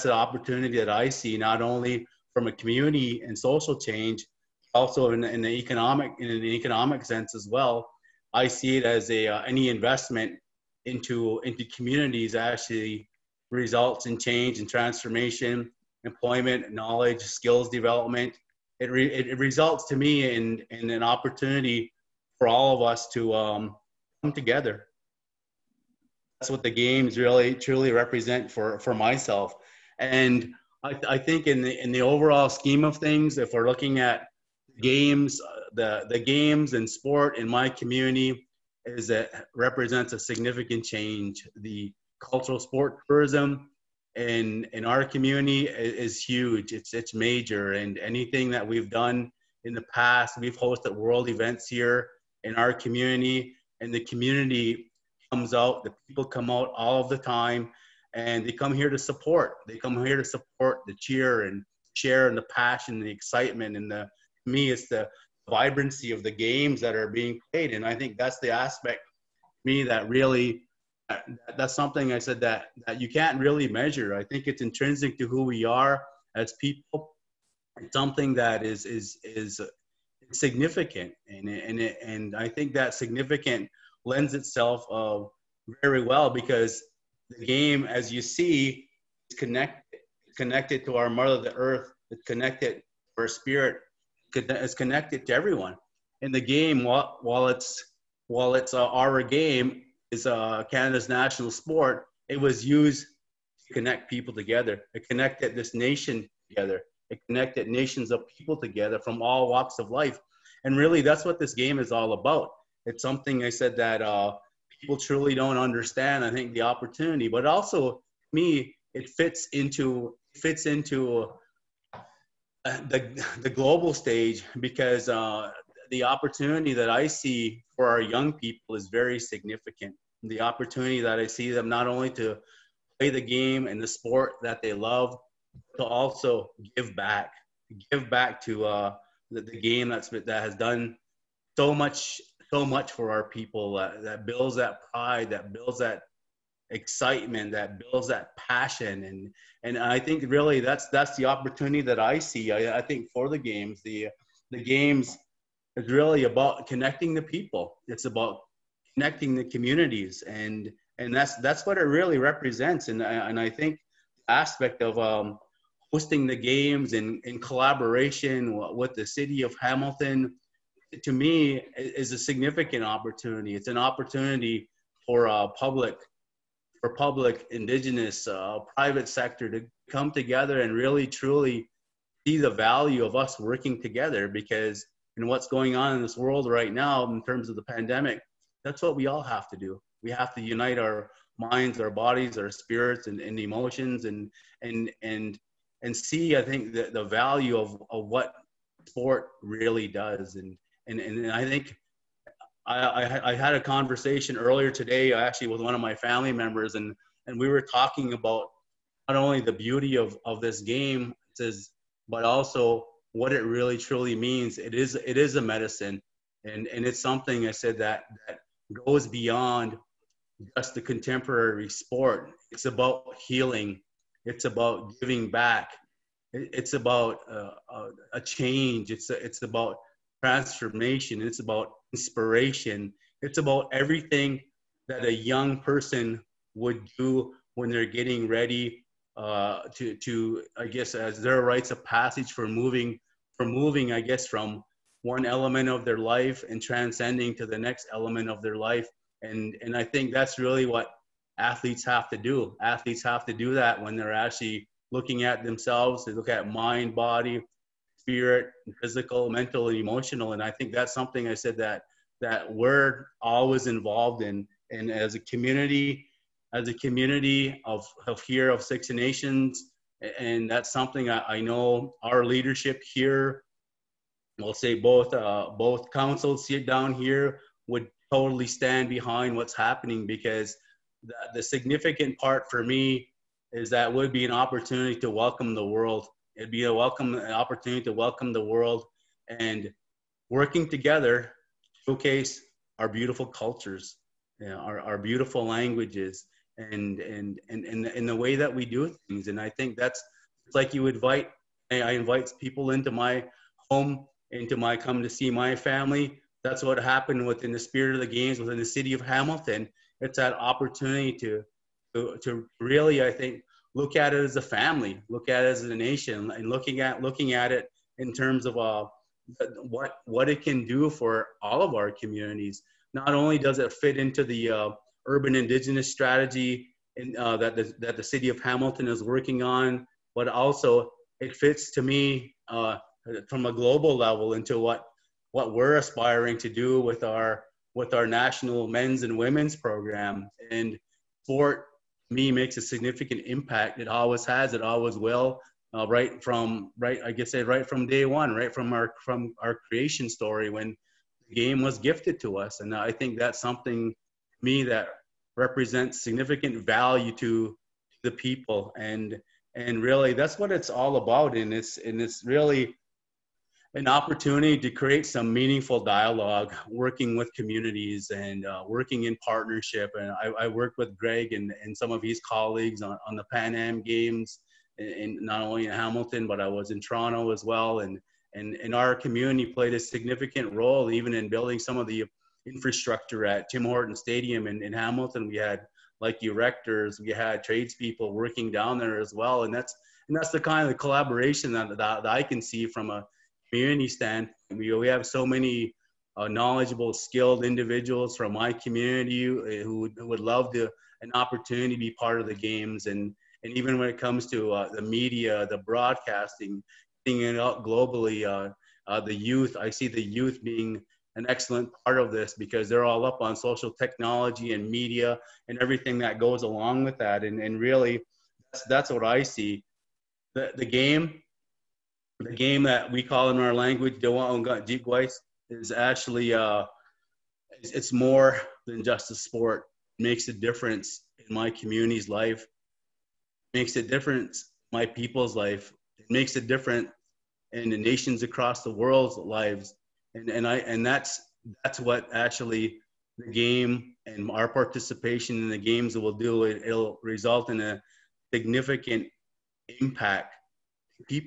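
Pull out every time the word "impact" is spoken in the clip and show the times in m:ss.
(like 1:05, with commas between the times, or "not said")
5:43, 7:29.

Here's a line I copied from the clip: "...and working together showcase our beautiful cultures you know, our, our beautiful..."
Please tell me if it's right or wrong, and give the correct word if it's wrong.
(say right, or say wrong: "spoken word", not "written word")
right.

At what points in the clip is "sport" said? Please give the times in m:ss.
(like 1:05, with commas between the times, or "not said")
0:36, 0:42, 1:41, 2:13, 3:18, 3:41, 5:41, 7:09.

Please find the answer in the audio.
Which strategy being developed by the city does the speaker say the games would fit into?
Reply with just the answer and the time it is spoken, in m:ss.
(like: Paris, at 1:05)
Urban indigenous strategy, at 5:25.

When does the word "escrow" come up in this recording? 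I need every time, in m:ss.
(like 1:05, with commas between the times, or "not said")
not said.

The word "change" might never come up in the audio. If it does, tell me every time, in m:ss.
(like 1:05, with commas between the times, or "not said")
0:03, 0:14, 0:40, 3:48.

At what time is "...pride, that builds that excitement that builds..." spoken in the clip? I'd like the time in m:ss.
2:24.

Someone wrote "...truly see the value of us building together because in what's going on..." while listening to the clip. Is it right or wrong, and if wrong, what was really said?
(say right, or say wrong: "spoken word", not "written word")
wrong: "working", not "building".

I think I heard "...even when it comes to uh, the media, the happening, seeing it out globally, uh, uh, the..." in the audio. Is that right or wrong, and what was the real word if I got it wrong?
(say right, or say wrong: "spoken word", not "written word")
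wrong: "broadcasting", not "happening".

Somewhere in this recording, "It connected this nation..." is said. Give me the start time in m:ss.
1:44.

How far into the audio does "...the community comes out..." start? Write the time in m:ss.
0:53.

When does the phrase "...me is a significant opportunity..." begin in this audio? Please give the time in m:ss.
2:51.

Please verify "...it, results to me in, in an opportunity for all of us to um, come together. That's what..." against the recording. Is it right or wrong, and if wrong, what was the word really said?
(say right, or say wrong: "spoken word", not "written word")
right.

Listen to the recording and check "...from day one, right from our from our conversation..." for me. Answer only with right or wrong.
wrong.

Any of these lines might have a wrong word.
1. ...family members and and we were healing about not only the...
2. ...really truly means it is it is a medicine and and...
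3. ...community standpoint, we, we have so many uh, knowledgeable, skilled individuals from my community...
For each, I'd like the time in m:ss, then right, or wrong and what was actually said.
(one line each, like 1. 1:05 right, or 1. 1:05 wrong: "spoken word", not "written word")
1. 3:25 wrong: "talking", not "healing"
2. 3:33 right
3. 6:33 right.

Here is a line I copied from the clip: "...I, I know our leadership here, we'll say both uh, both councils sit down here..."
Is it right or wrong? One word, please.
right.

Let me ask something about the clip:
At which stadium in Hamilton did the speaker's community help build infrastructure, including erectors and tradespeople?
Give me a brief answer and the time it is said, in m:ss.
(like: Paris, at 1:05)
Tim Horton Stadium, at 6:23.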